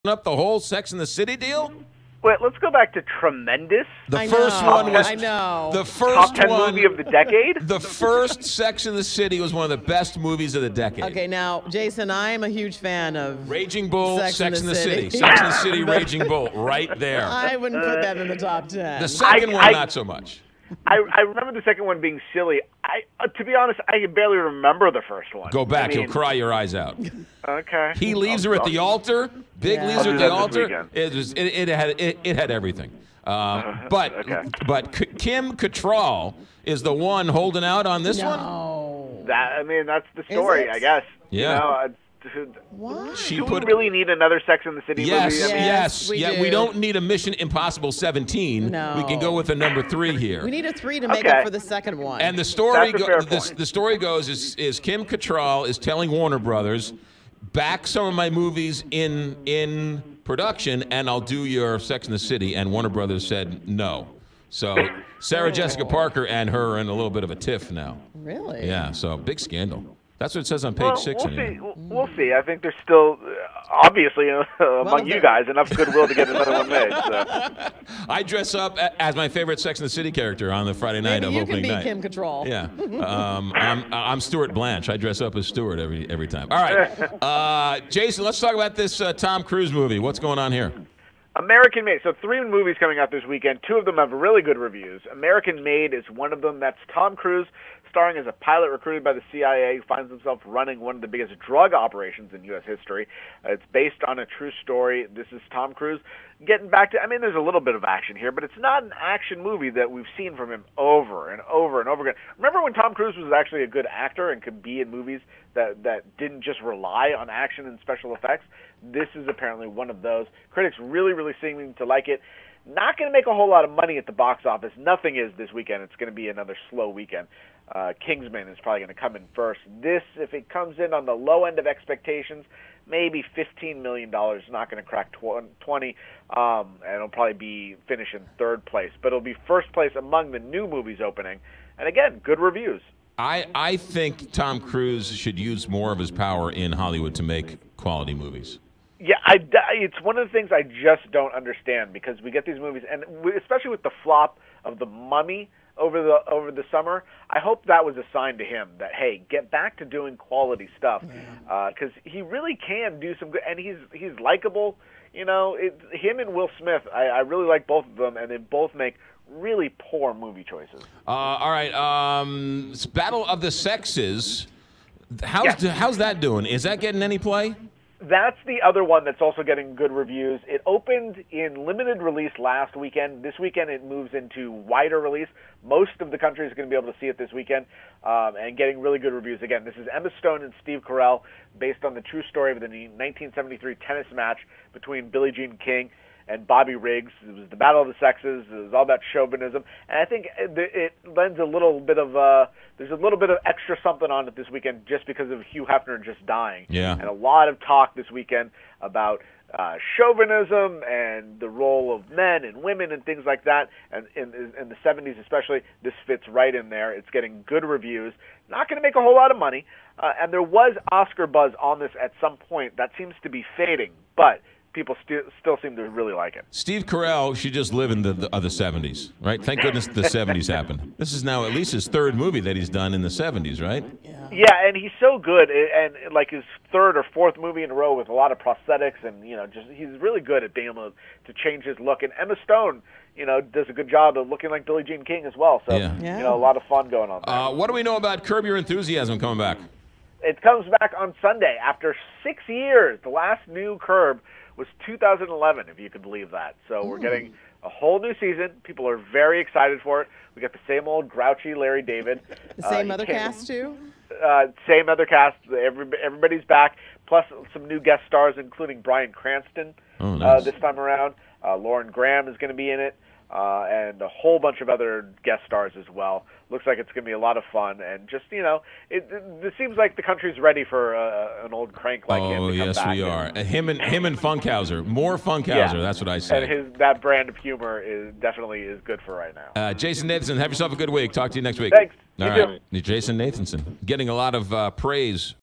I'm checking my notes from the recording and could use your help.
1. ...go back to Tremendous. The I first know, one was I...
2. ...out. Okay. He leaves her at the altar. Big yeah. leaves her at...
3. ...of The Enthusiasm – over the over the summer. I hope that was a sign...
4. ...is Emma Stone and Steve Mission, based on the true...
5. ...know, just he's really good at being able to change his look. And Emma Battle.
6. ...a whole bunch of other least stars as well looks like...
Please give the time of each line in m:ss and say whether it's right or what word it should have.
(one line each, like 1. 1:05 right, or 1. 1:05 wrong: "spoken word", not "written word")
1. 0:02 right
2. 0:26 right
3. 2:34 wrong: "Mummy", not "Enthusiasm"
4. 3:09 wrong: "Carell", not "Mission"
5. 3:59 wrong: "Stone", not "Battle"
6. 4:33 wrong: "guest", not "least".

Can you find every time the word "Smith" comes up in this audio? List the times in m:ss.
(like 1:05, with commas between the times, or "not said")
2:46.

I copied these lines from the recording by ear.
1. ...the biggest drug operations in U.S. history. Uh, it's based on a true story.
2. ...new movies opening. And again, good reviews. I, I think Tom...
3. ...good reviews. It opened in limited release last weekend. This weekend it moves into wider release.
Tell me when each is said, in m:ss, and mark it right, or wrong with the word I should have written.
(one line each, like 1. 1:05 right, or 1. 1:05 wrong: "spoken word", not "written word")
1. 1:41 right
2. 2:20 right
3. 2:59 right.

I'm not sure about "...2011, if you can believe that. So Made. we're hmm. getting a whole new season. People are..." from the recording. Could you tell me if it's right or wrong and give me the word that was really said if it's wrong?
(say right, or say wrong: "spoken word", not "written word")
wrong: "Ooh", not "Made".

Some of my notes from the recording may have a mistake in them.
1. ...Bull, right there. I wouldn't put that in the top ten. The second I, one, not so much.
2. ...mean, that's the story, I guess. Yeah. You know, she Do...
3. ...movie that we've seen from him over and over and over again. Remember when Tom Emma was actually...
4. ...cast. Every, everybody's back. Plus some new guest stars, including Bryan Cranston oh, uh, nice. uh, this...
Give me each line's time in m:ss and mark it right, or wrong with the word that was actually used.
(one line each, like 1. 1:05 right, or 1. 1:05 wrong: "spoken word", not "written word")
1. 0:16 right
2. 0:39 right
3. 1:49 wrong: "Cruise", not "Emma"
4. 4:25 right.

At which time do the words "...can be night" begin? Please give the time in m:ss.
1:21.